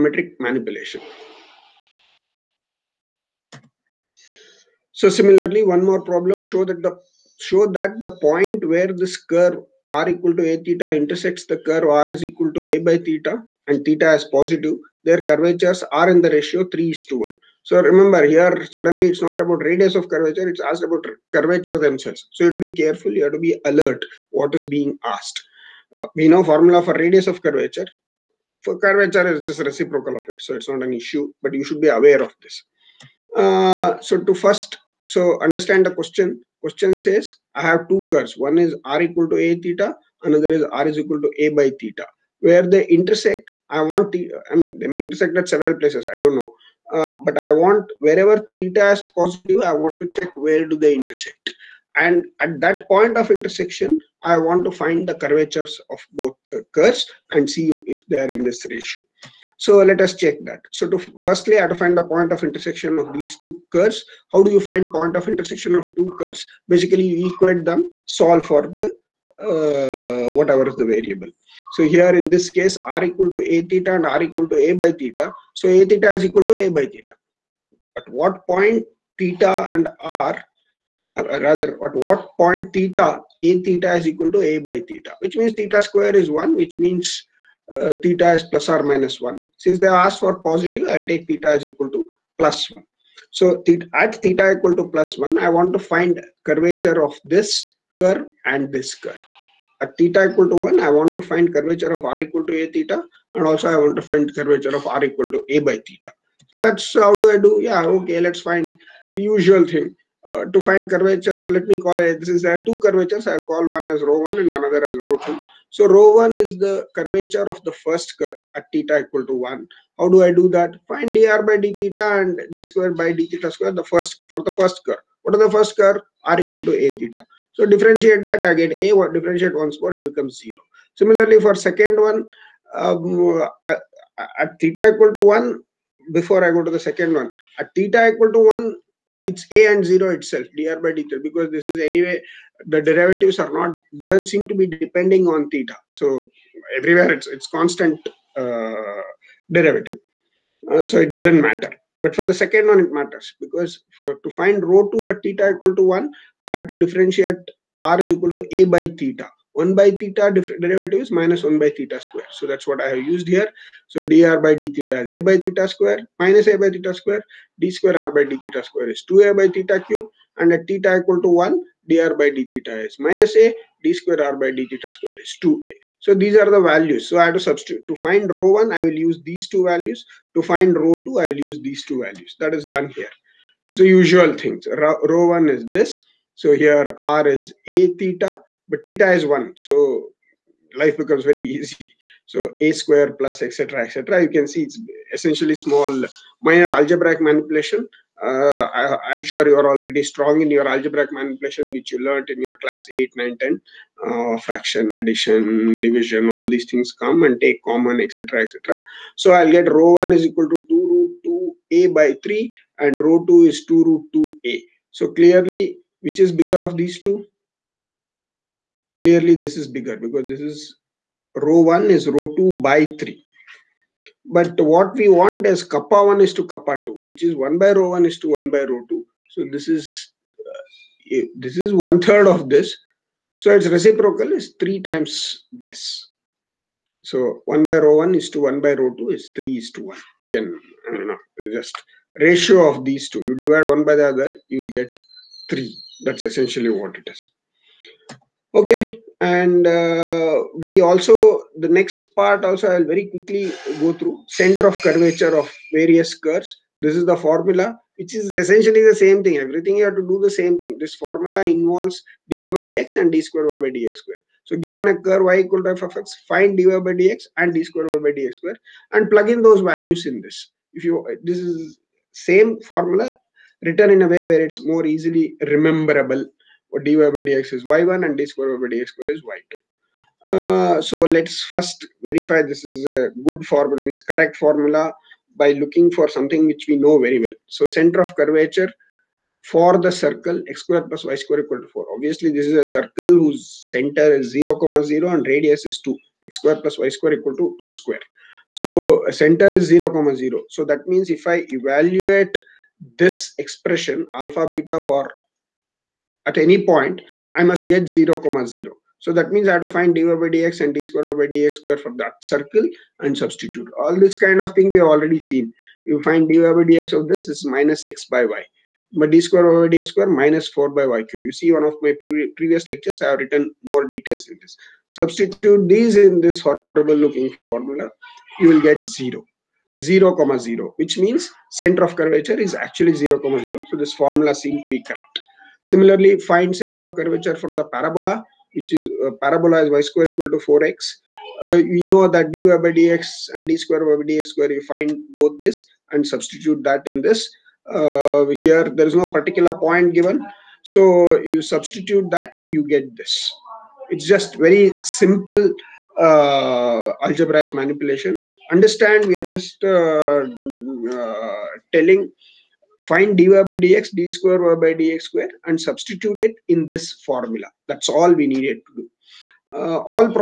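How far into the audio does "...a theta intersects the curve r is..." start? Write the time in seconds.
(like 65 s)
10 s.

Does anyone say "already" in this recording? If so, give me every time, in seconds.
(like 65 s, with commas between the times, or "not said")
314 s.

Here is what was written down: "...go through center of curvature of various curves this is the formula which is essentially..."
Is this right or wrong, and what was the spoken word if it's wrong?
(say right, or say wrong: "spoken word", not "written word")
right.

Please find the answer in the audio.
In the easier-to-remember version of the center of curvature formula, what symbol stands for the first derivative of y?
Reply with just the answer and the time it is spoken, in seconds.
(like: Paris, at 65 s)
y1, at 277 s.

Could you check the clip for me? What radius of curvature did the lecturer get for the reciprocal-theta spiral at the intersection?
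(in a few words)
2 root 2a.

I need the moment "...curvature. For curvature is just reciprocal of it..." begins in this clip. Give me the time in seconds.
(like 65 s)
27 s.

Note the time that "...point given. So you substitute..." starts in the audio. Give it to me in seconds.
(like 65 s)
349 s.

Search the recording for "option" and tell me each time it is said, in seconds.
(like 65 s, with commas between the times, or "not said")
not said.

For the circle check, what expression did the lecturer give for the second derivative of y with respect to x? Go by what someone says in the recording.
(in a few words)
minus 4 by y cube.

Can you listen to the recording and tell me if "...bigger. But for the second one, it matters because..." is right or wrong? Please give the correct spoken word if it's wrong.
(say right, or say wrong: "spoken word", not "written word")
wrong: "matter", not "bigger".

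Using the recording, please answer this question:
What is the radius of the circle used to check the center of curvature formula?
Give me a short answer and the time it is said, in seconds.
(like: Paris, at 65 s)
2, at 295 s.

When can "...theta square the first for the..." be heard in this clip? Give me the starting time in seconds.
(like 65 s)
123 s.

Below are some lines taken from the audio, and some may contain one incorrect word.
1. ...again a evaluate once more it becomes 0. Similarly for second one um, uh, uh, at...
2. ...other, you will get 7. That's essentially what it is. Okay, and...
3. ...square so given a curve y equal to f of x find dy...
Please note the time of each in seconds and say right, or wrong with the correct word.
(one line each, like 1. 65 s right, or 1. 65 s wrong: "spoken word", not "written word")
1. 128 s wrong: "differentiate", not "evaluate"
2. 244 s wrong: "3", not "7"
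3. 263 s right.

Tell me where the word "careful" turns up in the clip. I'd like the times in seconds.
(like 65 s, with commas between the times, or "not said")
22 s.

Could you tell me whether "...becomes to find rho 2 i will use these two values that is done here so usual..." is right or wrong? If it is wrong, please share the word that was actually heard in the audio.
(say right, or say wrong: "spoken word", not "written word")
wrong: "values", not "becomes".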